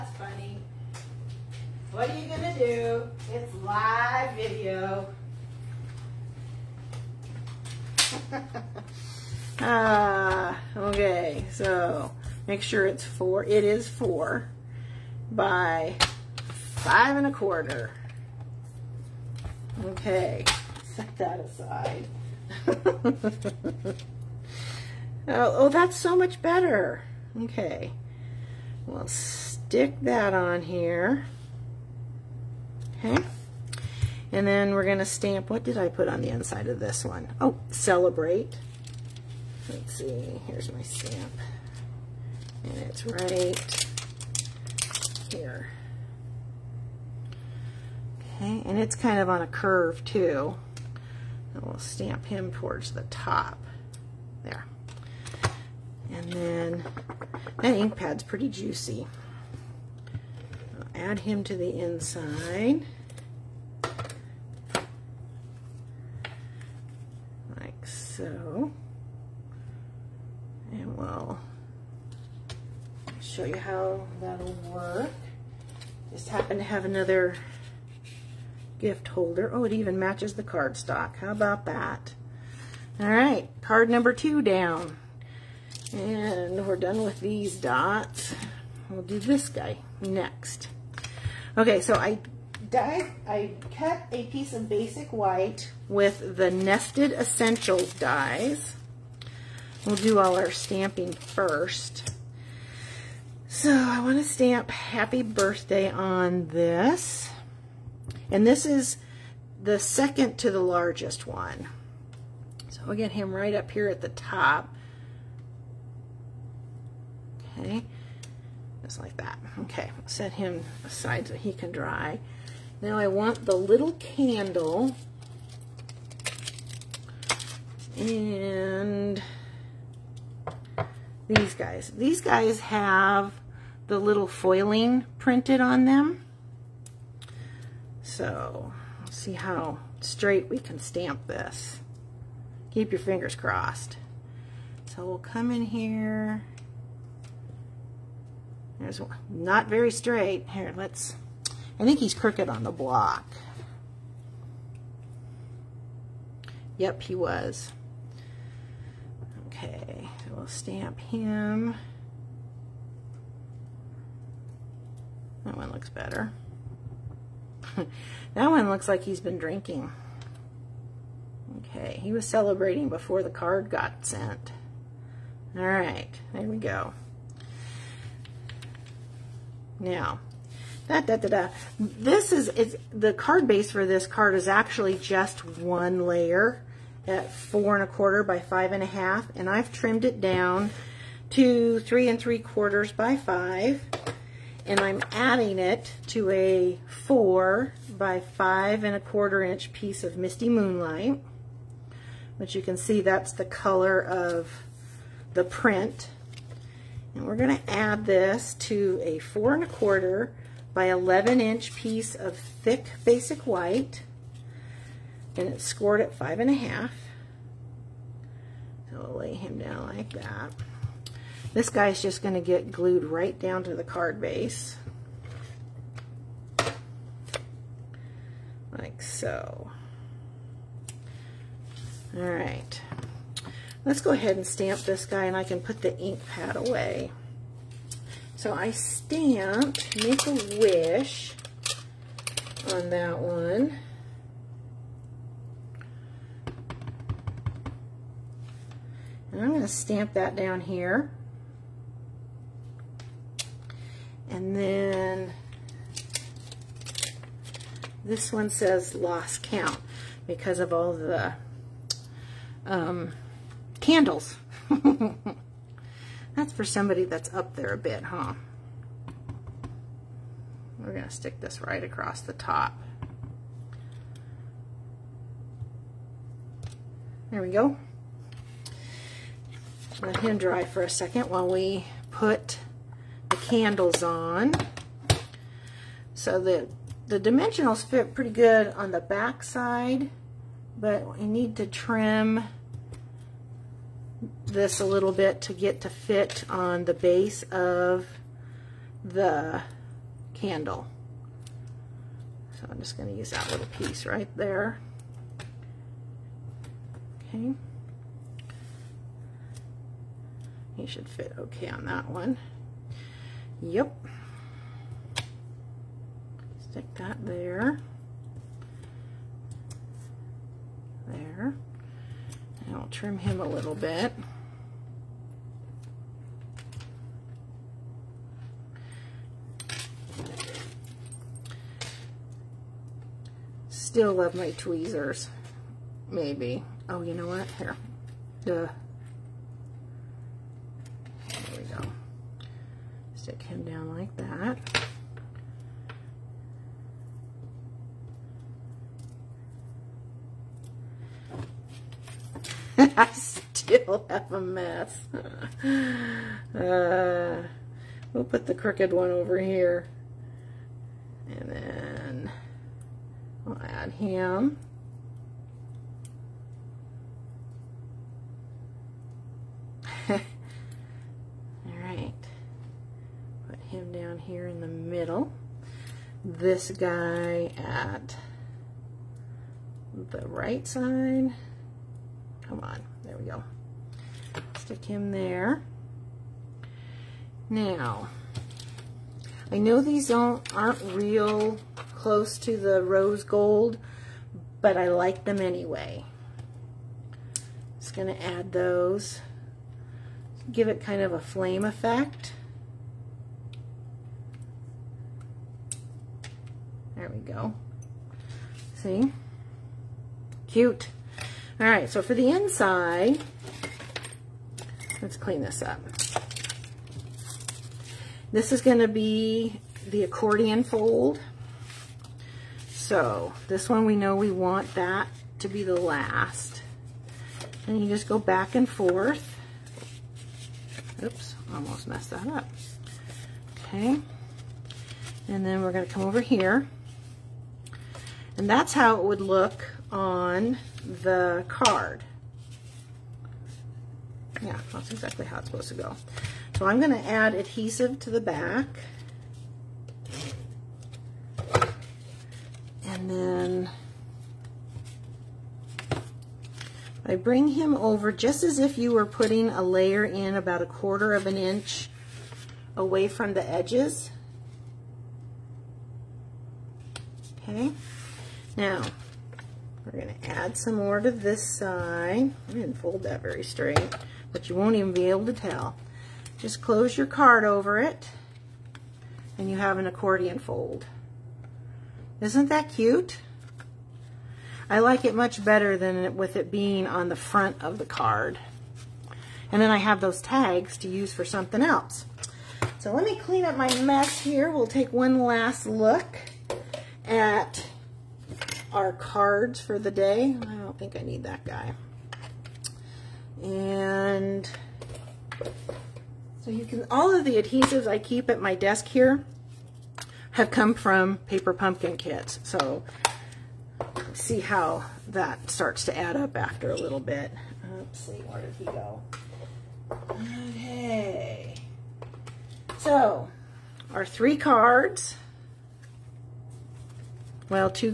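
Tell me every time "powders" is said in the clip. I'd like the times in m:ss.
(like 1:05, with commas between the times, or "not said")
not said.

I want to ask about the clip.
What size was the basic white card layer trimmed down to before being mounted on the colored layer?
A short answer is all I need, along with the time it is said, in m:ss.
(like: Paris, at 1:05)
3 3/4 by 5, at 3:11.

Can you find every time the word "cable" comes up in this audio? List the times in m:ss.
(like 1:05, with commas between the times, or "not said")
not said.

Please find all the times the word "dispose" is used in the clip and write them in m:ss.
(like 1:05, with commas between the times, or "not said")
not said.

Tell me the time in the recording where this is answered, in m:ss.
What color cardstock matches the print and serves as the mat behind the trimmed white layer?
3:20.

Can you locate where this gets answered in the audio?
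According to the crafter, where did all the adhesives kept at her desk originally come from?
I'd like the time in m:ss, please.
8:31.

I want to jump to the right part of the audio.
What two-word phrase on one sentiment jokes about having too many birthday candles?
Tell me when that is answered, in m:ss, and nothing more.
4:18.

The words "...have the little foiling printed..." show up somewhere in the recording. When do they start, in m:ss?
2:12.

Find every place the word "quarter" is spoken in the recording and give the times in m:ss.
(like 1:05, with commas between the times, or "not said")
0:17, 3:07, 3:12, 3:19, 3:29, 7:40.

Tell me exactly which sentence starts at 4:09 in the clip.
And I'm going to stamp that down here.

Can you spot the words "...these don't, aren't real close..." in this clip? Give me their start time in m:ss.
6:29.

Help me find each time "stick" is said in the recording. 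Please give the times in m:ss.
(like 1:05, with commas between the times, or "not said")
0:29, 4:31, 5:16, 6:24.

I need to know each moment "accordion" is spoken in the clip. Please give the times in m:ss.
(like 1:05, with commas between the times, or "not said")
7:00, 7:59.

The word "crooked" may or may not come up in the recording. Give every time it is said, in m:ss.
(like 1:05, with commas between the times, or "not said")
2:32, 5:58.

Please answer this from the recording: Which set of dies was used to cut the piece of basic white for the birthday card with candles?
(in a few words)
Nested Essentials.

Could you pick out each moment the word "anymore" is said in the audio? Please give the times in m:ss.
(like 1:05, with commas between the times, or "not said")
not said.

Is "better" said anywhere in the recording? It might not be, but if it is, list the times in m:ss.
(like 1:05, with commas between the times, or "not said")
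0:26, 2:45, 8:05.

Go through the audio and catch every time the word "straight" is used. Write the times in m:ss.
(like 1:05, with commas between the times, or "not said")
2:20, 2:29, 7:53.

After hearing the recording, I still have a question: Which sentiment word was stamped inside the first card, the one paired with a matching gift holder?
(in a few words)
Celebrate.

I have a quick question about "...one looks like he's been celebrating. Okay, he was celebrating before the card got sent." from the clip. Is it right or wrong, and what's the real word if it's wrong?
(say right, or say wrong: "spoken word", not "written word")
wrong: "drinking", not "celebrating".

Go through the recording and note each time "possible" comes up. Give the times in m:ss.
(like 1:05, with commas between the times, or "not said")
not said.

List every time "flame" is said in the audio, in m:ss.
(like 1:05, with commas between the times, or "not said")
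6:41.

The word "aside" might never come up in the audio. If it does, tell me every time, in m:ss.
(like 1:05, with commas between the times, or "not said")
0:21, 2:00.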